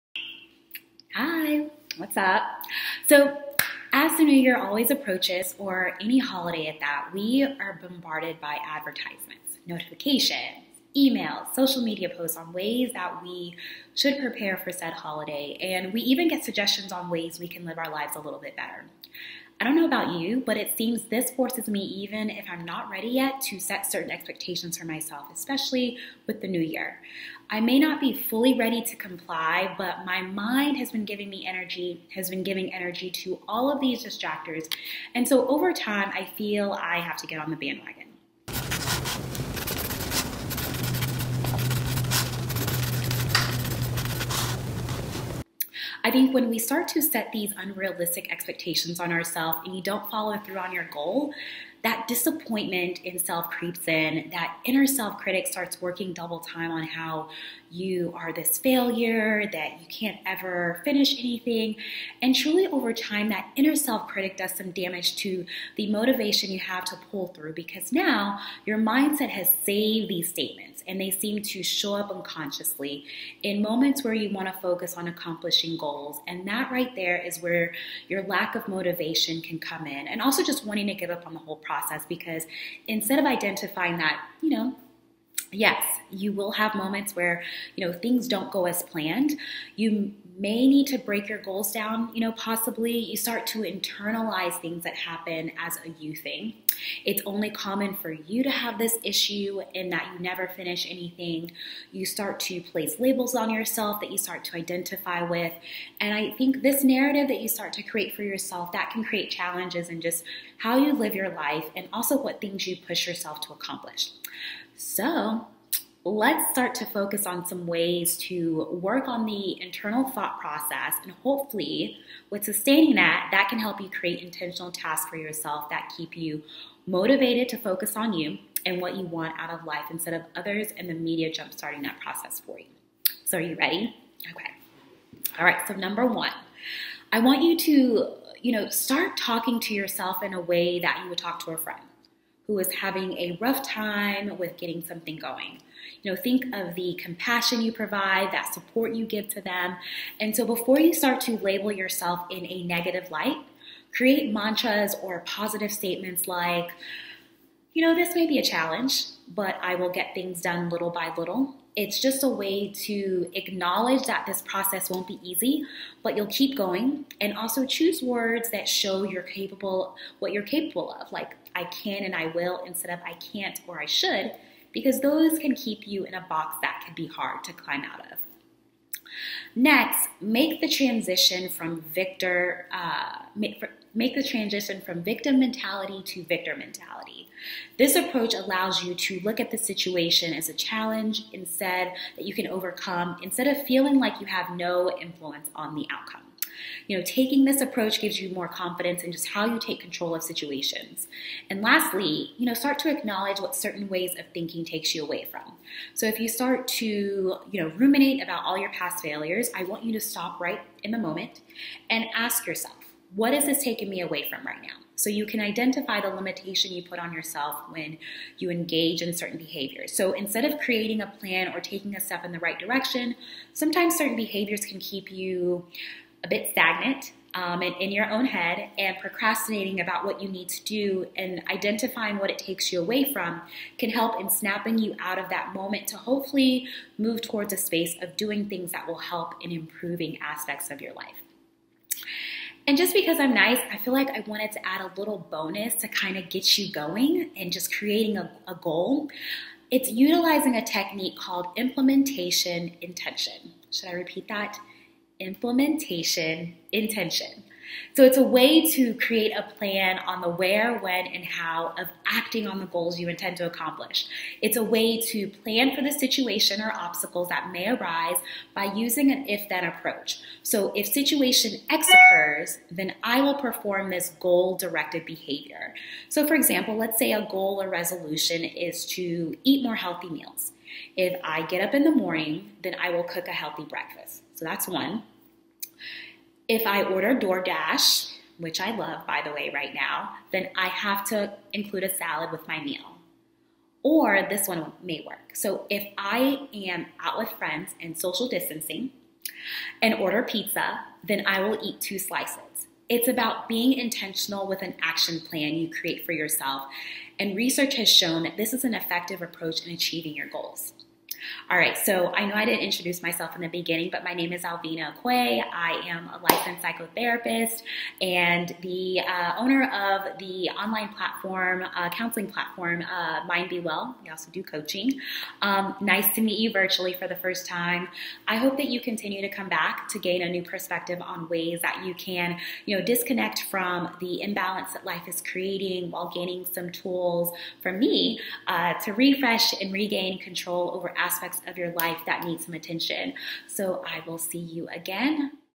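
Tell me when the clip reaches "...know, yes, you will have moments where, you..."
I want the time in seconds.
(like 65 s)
84 s.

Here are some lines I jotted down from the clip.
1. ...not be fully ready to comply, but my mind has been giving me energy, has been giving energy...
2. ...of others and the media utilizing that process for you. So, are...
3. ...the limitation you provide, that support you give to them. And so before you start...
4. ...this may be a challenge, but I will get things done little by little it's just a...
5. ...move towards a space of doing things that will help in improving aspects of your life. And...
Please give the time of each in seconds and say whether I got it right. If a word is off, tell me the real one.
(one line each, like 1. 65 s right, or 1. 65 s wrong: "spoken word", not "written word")
1. 27 s right
2. 130 s wrong: "jumpstarting", not "utilizing"
3. 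146 s wrong: "compassion", not "limitation"
4. 157 s right
5. 236 s right.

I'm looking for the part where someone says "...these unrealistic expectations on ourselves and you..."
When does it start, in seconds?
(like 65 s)
47 s.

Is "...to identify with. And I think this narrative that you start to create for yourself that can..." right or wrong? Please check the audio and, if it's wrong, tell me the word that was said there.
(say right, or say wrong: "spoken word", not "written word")
right.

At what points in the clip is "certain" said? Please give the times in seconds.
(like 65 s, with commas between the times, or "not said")
23 s, 203 s, 219 s, 223 s.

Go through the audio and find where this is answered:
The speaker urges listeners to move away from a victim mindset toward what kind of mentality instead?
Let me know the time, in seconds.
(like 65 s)
186 s.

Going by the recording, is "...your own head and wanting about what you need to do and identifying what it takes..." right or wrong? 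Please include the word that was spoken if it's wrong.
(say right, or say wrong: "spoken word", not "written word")
wrong: "procrastinating", not "wanting".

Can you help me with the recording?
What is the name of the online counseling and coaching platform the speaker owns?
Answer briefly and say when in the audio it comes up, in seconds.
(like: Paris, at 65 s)
Mind Be Well, at 323 s.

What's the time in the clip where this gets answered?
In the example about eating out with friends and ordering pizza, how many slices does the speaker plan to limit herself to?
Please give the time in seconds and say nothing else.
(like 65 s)
301 s.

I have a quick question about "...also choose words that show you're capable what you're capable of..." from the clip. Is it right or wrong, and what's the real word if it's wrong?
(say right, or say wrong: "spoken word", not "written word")
right.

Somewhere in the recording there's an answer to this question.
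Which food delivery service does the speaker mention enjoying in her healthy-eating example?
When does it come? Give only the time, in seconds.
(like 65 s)
287 s.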